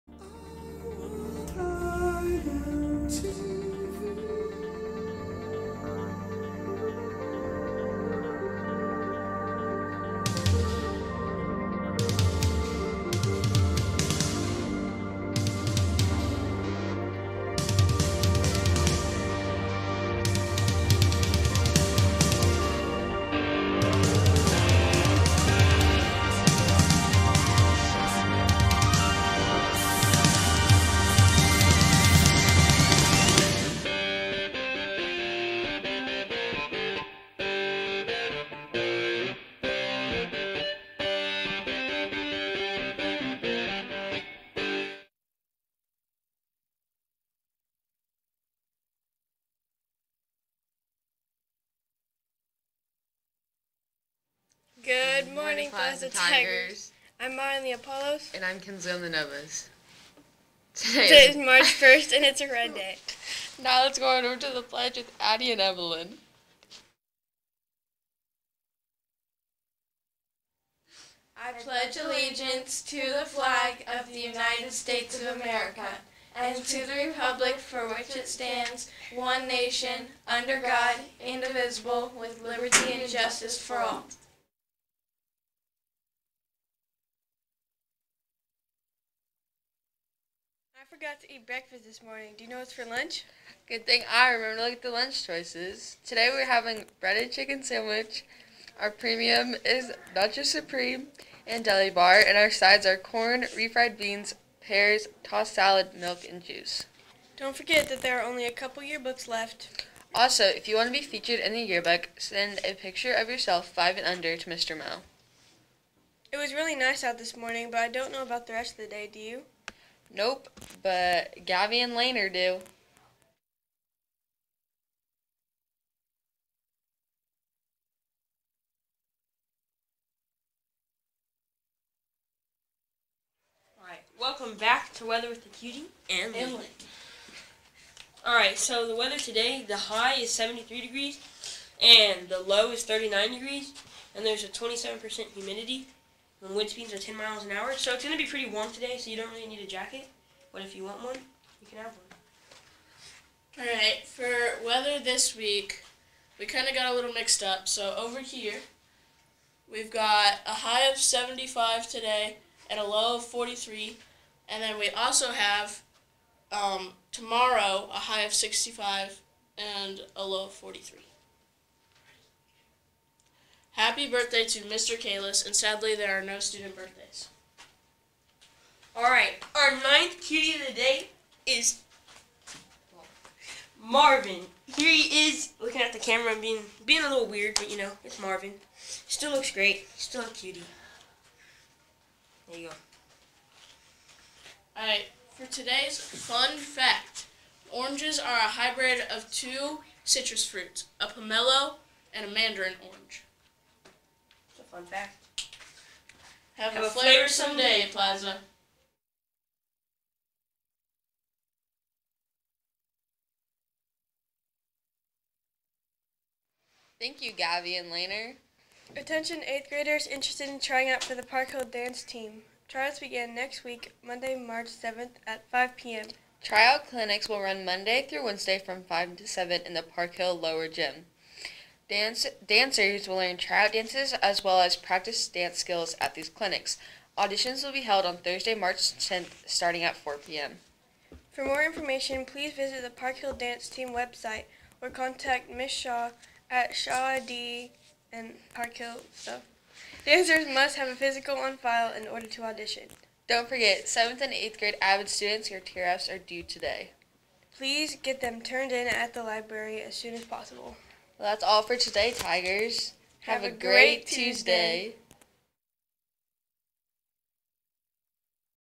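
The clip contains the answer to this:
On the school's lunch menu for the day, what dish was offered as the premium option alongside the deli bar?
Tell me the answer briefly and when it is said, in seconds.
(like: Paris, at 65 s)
Nacho Supreme, at 100 s.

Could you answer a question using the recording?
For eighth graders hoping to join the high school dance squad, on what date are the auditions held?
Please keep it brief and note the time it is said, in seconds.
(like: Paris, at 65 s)
March 10th, at 238 s.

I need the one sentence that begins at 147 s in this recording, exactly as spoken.
So it's going to be pretty warm today, so you don't really need a jacket.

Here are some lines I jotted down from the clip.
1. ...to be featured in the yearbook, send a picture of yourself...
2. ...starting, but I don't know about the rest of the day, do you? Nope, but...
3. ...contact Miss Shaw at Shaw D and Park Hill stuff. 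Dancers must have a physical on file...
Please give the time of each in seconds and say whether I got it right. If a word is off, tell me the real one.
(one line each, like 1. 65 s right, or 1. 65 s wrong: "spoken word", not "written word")
1. 110 s right
2. 117 s wrong: "morning", not "starting"
3. 244 s right.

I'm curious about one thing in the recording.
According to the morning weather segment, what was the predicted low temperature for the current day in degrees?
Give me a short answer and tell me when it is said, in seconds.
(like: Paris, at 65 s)
39, at 142 s.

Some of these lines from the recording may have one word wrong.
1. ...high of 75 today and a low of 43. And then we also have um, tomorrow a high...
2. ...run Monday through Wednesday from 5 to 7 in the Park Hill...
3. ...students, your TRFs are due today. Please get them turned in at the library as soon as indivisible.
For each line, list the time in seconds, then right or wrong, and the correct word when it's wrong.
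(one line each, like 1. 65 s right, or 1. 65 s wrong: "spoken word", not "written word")
1. 160 s right
2. 227 s right
3. 255 s wrong: "possible", not "indivisible".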